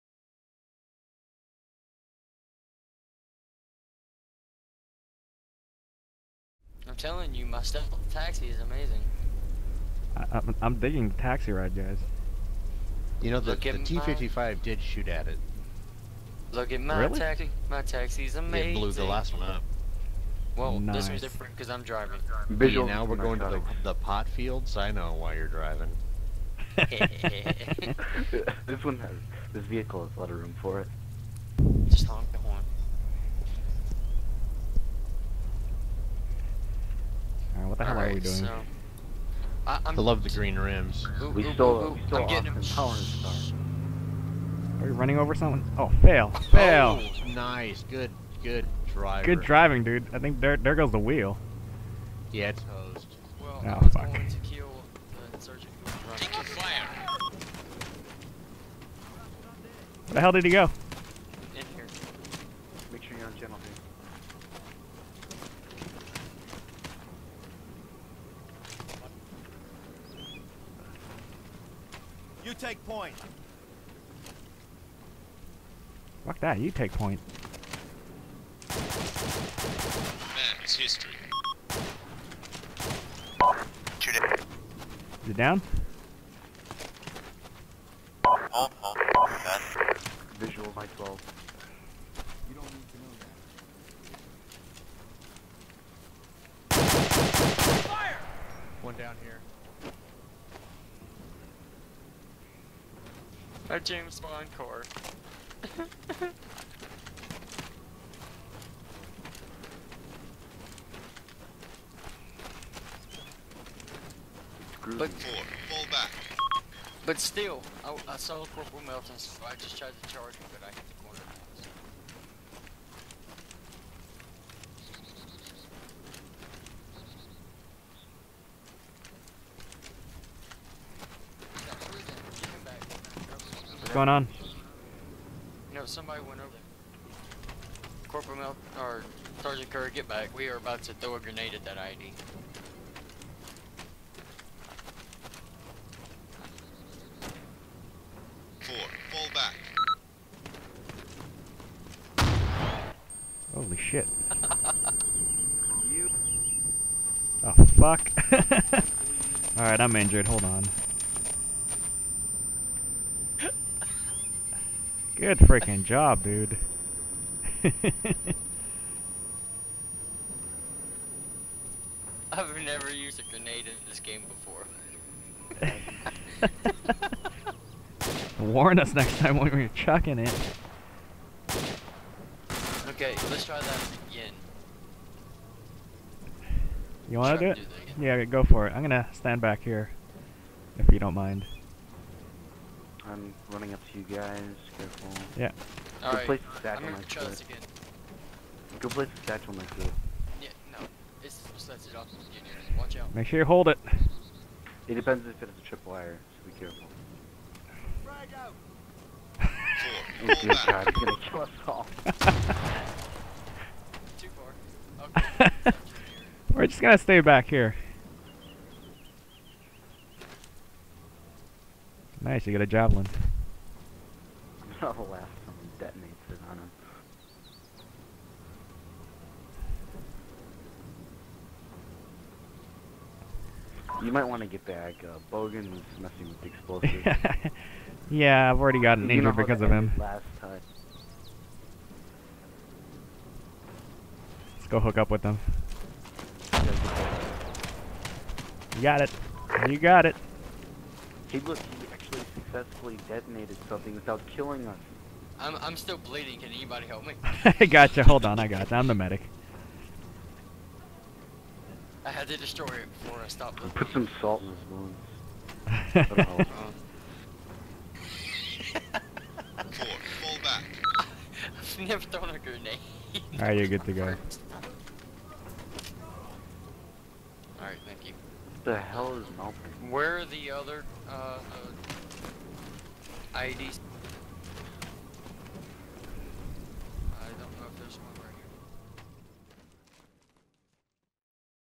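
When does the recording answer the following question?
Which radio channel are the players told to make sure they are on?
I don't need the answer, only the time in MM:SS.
01:03.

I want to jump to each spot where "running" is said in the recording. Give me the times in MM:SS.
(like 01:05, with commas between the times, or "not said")
00:44, 03:13.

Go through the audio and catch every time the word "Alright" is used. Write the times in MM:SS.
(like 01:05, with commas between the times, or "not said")
02:39, 04:33, 04:37.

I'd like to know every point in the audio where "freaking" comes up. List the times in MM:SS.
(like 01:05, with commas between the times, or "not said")
02:45.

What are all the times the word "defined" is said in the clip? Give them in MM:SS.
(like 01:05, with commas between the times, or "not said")
not said.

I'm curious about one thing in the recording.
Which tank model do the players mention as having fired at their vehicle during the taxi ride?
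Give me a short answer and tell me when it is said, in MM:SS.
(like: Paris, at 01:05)
T-55, at 00:13.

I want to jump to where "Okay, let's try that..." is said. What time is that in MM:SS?
03:02.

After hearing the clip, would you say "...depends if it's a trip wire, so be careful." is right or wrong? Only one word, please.
right.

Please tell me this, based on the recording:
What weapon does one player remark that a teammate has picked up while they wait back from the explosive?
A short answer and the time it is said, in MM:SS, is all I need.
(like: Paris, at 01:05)
Javelin, at 03:42.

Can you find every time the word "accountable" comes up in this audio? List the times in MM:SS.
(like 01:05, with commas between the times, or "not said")
not said.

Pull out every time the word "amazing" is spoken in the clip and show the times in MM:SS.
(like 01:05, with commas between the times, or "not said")
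00:08, 00:18.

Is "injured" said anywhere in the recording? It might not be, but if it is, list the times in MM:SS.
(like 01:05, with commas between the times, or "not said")
02:39, 03:59.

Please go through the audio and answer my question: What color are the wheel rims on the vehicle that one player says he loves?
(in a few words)
Green.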